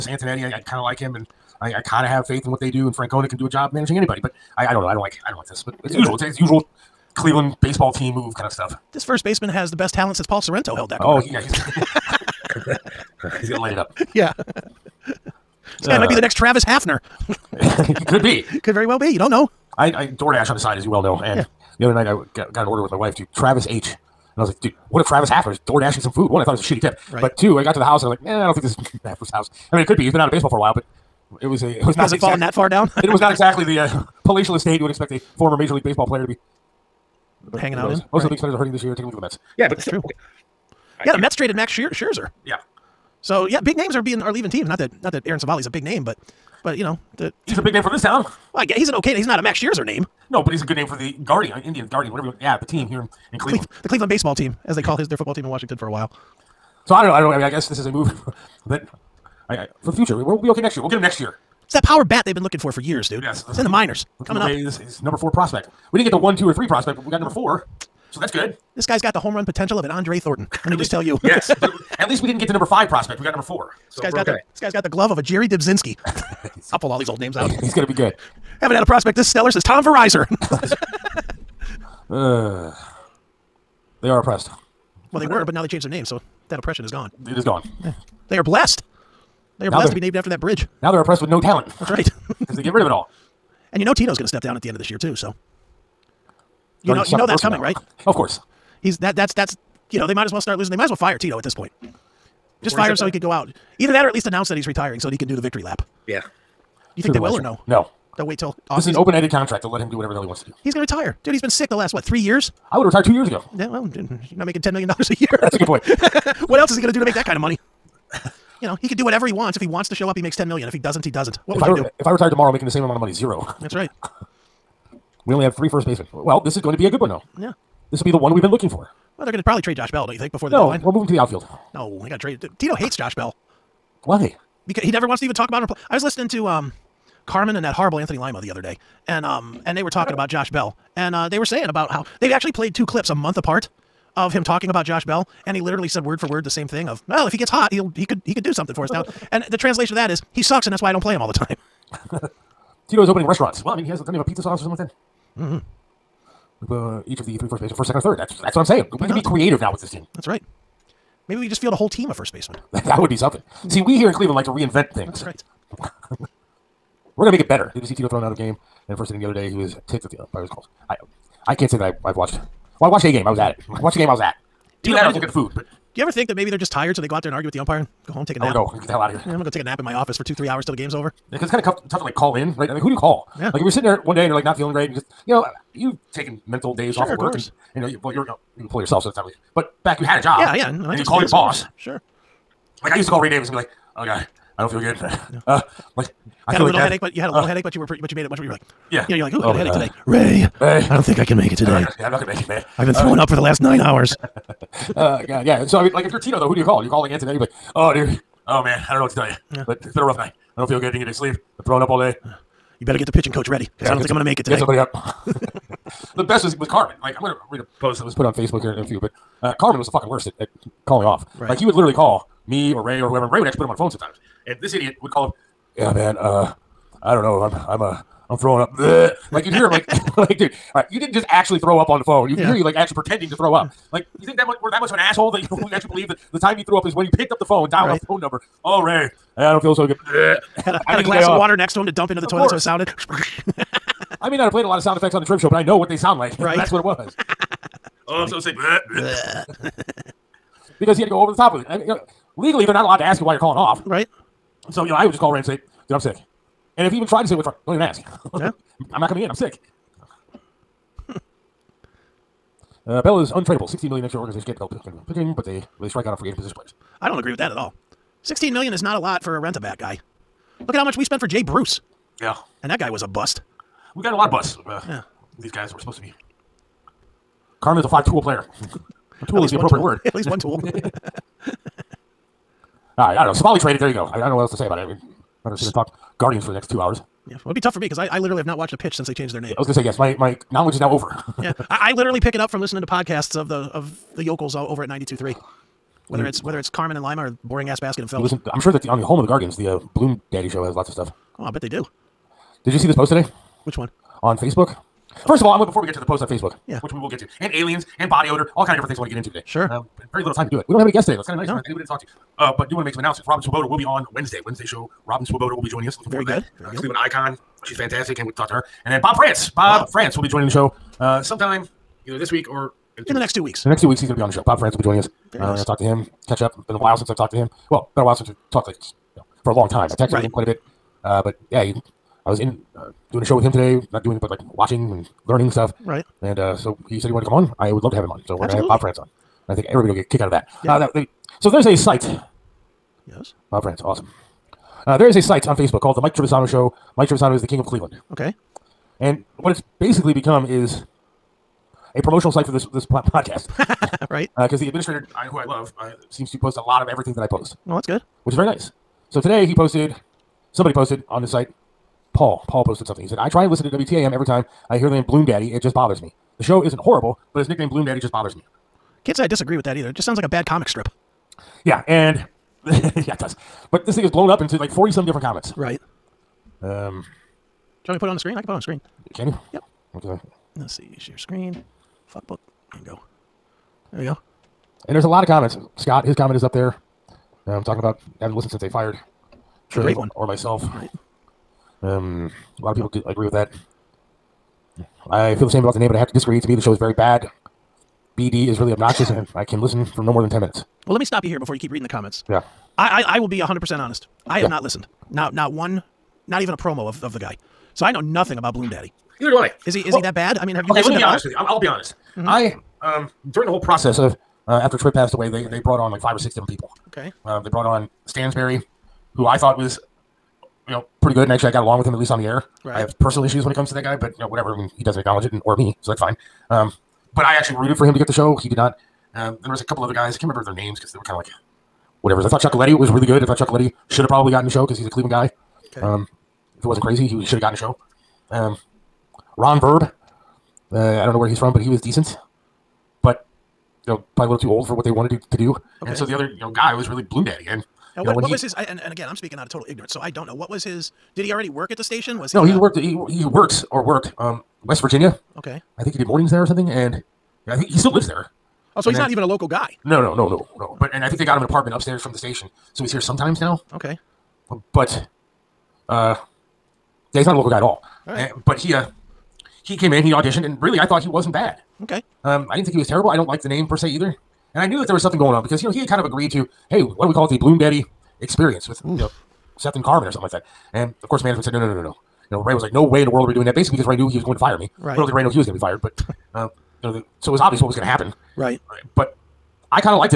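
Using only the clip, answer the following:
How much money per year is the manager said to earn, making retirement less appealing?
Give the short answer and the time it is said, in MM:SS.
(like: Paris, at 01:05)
10 million dollars, at 01:54.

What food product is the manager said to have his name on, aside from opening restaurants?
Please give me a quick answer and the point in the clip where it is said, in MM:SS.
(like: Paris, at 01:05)
pizza sauce, at 02:34.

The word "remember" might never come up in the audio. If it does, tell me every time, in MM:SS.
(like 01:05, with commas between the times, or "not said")
07:10.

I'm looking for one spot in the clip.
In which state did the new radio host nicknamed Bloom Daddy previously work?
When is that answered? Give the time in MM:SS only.
07:34.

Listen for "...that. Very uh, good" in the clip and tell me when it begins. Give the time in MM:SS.
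05:16.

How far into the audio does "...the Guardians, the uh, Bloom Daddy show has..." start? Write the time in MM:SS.
04:59.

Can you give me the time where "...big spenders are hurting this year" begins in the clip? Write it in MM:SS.
00:38.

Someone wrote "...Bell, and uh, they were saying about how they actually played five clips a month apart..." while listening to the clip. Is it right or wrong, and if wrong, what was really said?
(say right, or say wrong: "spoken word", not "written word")
wrong: "two", not "five".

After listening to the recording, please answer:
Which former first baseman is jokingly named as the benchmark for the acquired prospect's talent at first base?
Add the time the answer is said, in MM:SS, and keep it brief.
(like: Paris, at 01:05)
Paul Sorrento, at 00:10.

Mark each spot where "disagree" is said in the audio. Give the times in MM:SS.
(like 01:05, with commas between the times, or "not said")
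06:09, 06:36.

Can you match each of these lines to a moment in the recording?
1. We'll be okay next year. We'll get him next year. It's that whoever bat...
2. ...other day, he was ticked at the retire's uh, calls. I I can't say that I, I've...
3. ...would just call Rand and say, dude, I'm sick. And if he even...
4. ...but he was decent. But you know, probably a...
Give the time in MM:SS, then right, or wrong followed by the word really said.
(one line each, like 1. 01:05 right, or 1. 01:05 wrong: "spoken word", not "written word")
1. 01:00 wrong: "power", not "whoever"
2. 02:49 wrong: "umpire", not "retire"
3. 04:15 right
4. 07:21 right.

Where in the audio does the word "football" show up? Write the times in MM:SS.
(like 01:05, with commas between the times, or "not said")
00:55.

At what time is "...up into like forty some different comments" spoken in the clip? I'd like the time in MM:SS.
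06:14.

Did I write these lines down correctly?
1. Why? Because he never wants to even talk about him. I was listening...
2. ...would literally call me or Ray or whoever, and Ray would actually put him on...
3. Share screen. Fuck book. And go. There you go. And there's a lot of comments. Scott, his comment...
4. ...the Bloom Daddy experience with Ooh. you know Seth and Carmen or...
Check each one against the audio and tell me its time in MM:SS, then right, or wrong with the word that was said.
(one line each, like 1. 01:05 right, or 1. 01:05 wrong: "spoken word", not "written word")
1. 02:14 right
2. 03:41 right
3. 06:20 right
4. 07:57 right.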